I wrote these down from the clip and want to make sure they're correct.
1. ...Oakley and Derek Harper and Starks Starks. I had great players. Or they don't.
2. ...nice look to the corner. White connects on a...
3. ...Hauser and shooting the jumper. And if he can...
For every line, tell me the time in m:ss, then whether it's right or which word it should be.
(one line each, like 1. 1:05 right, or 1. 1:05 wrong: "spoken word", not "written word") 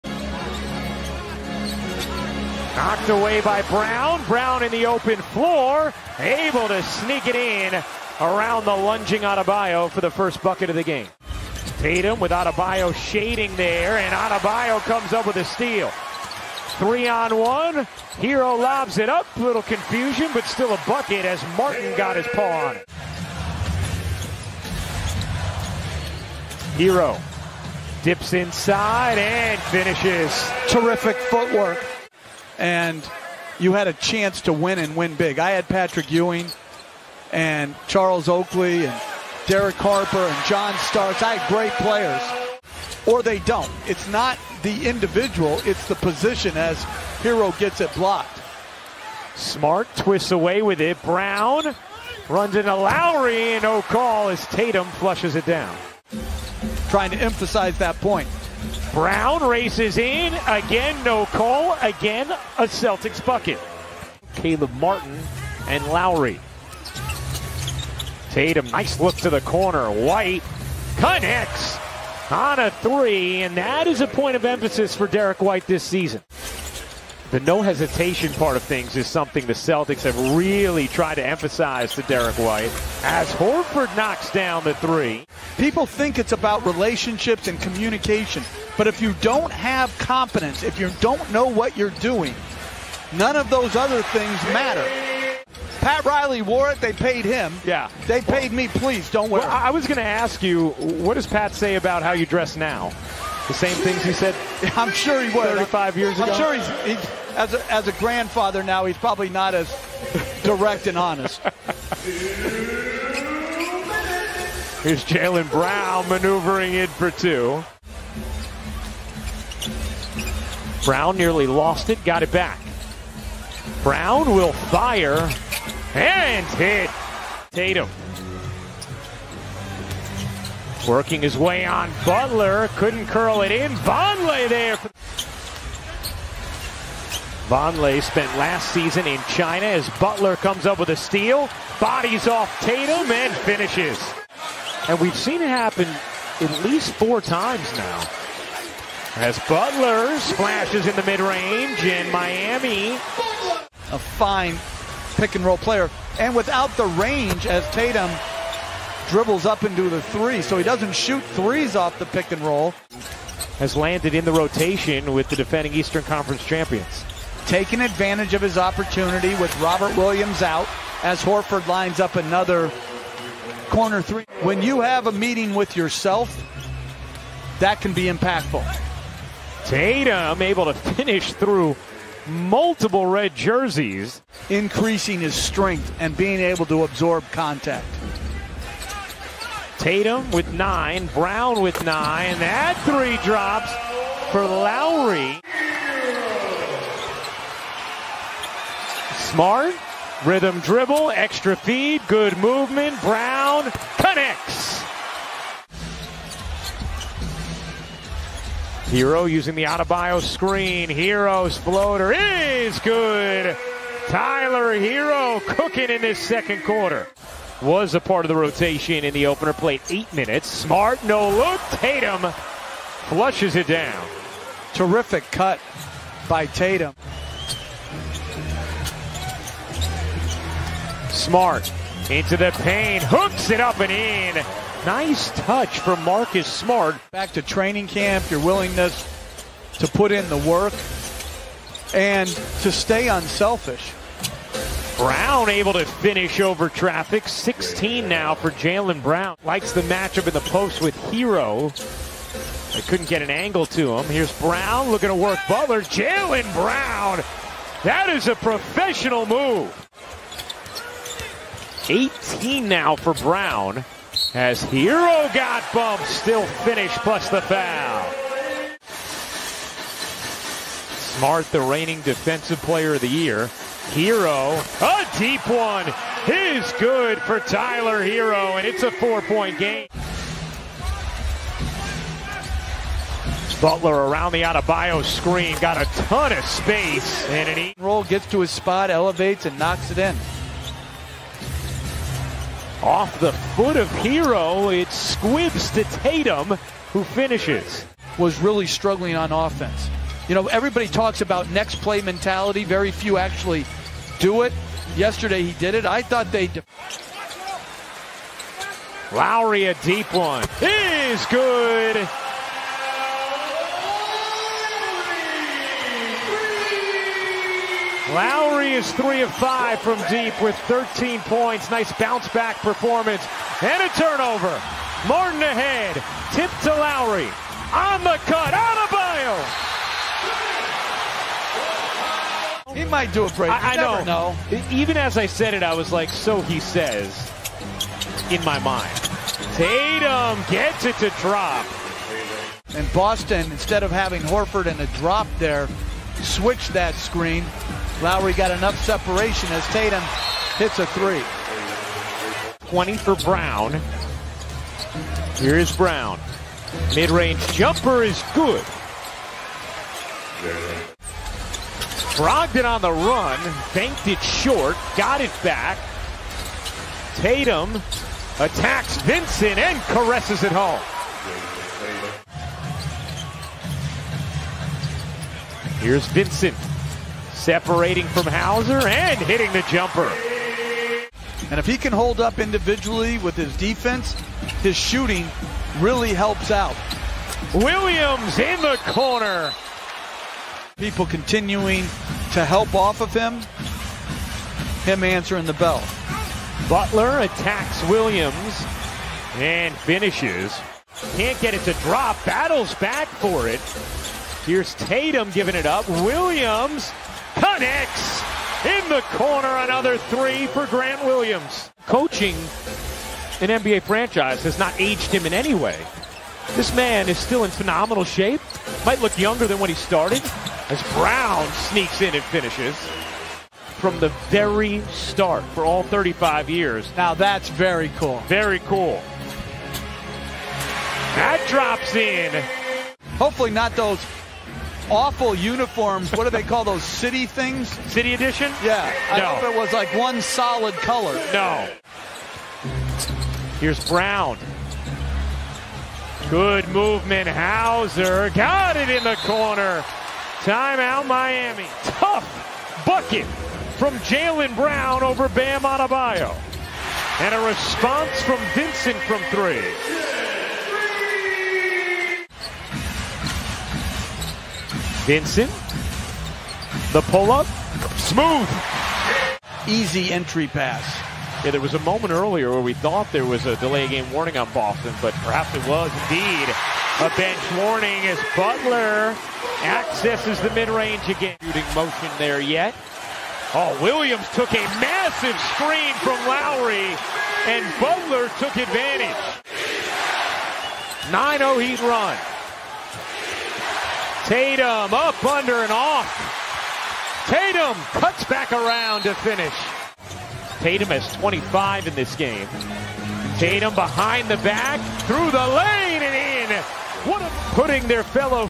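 1. 0:38 wrong: "John", not "Starks"
2. 1:08 right
3. 6:18 wrong: "hitting", not "shooting".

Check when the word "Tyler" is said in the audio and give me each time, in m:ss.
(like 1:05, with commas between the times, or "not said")
3:34, 4:37.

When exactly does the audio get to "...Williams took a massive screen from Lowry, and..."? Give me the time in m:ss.
8:03.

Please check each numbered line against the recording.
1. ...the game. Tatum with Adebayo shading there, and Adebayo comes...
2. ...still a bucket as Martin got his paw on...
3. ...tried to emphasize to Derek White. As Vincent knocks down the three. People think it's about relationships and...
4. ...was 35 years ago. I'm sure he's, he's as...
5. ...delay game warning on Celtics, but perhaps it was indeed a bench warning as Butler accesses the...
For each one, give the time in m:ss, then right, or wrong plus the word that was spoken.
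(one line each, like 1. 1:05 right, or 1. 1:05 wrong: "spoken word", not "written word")
1. 0:10 right
2. 0:20 right
3. 1:20 wrong: "Horford", not "Vincent"
4. 1:45 right
5. 7:53 wrong: "Boston", not "Celtics".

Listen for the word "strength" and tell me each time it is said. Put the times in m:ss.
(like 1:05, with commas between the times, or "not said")
3:05.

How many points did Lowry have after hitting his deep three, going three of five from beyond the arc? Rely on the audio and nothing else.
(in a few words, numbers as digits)
13.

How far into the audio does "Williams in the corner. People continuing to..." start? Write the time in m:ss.
6:27.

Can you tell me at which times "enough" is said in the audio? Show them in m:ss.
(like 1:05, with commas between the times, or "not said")
5:48.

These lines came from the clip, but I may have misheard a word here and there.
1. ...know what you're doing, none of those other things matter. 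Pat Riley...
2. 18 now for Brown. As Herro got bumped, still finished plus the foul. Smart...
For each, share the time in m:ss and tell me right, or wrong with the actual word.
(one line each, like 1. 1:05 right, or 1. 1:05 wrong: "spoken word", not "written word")
1. 1:31 right
2. 4:21 right.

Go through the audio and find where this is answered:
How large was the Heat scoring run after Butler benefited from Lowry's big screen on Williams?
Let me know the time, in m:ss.
8:11.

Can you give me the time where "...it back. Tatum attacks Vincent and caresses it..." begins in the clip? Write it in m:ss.
6:05.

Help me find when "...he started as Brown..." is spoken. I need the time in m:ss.
6:59.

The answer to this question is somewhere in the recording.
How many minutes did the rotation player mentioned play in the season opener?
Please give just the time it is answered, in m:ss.
3:39.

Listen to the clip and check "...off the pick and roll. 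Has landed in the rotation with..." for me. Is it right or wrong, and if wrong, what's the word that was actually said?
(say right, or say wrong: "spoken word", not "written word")
right.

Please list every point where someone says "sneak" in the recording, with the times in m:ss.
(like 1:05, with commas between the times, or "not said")
0:06, 7:01.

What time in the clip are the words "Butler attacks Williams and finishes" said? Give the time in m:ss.
6:36.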